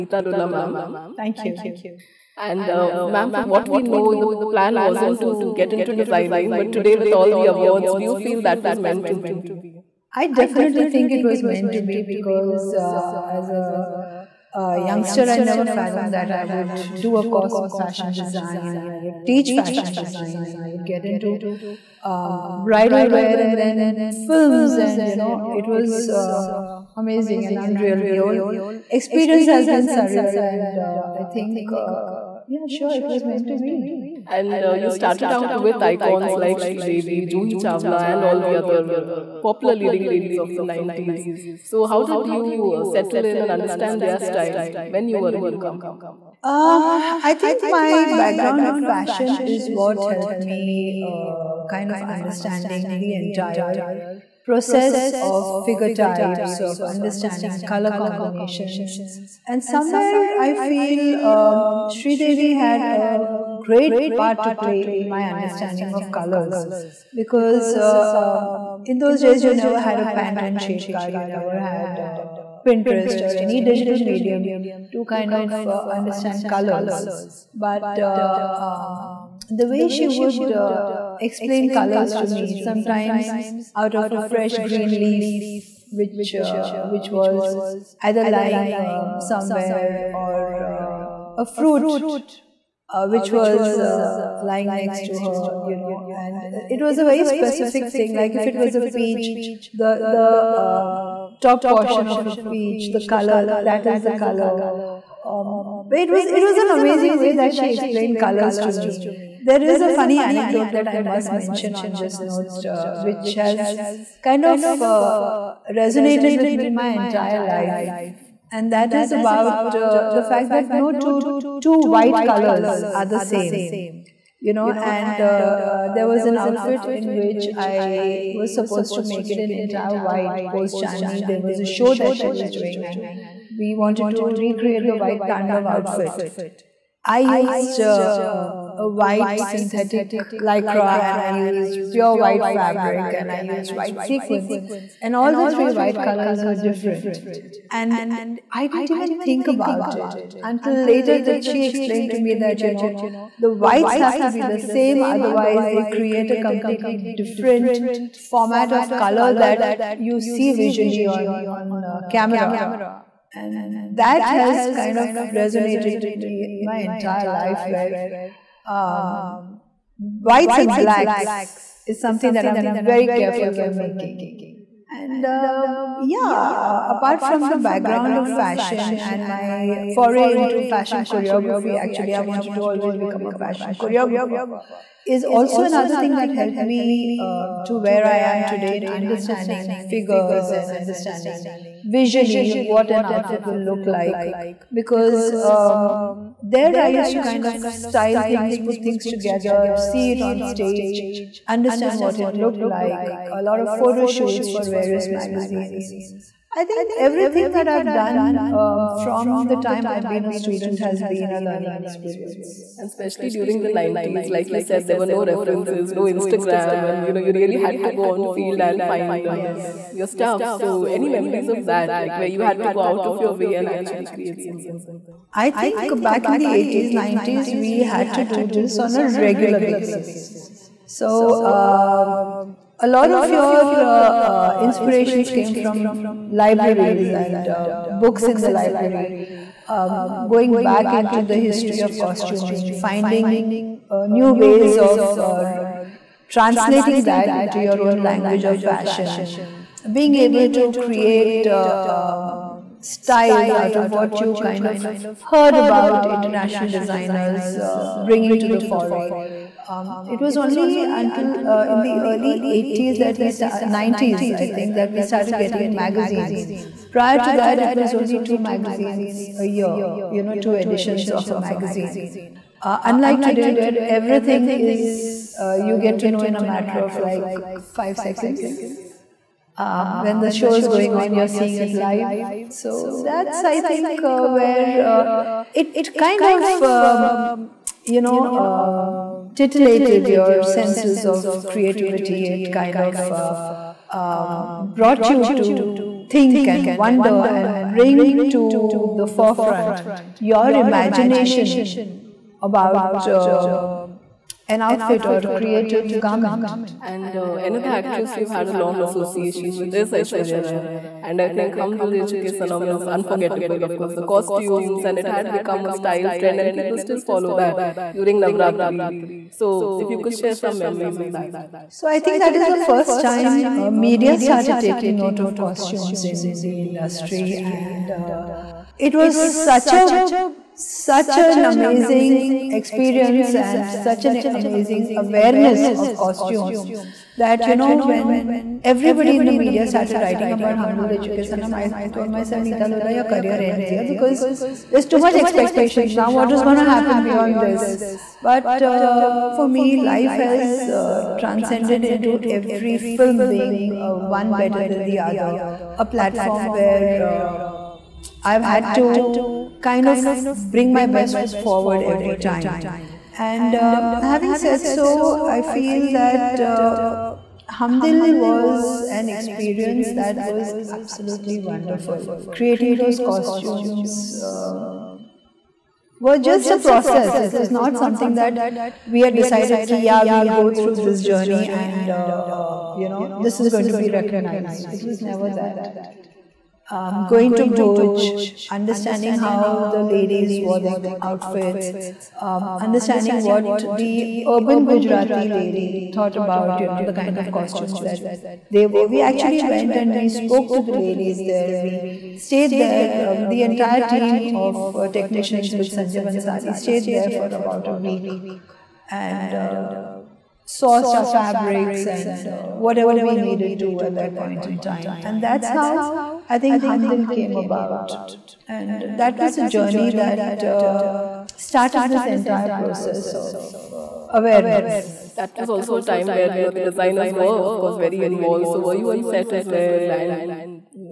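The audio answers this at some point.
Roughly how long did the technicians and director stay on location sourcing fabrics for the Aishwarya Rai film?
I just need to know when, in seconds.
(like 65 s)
407 s.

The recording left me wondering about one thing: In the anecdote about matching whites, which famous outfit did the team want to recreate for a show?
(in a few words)
The white Tandav outfit.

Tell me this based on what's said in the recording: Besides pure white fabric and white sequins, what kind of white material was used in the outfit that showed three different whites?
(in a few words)
White synthetic lycra.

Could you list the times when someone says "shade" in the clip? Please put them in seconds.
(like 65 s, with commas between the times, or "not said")
70 s.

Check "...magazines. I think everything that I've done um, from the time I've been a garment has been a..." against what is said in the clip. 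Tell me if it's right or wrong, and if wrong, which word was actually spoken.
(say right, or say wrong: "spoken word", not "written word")
wrong: "student", not "garment".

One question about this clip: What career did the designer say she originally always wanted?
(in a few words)
Fashion choreographer.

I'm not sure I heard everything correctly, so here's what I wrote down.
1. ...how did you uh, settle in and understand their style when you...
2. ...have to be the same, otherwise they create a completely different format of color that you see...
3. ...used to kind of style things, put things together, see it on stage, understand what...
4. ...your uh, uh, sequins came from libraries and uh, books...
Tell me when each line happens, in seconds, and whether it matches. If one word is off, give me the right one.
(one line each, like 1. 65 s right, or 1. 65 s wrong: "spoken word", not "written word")
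1. 41 s right
2. 153 s right
3. 196 s right
4. 233 s wrong: "inspirations", not "sequins".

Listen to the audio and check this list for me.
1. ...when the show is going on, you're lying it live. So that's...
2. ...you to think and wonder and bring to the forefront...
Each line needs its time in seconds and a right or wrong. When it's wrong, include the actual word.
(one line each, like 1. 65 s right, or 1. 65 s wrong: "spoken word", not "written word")
1. 280 s wrong: "seeing", not "lying"
2. 295 s right.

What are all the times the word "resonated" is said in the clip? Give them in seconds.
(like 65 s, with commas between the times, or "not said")
115 s, 165 s.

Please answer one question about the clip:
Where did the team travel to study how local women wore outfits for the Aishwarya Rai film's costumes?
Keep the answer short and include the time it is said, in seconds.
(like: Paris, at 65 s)
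Bhuj, at 387 s.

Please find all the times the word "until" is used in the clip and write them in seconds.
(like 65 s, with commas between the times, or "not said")
150 s, 260 s.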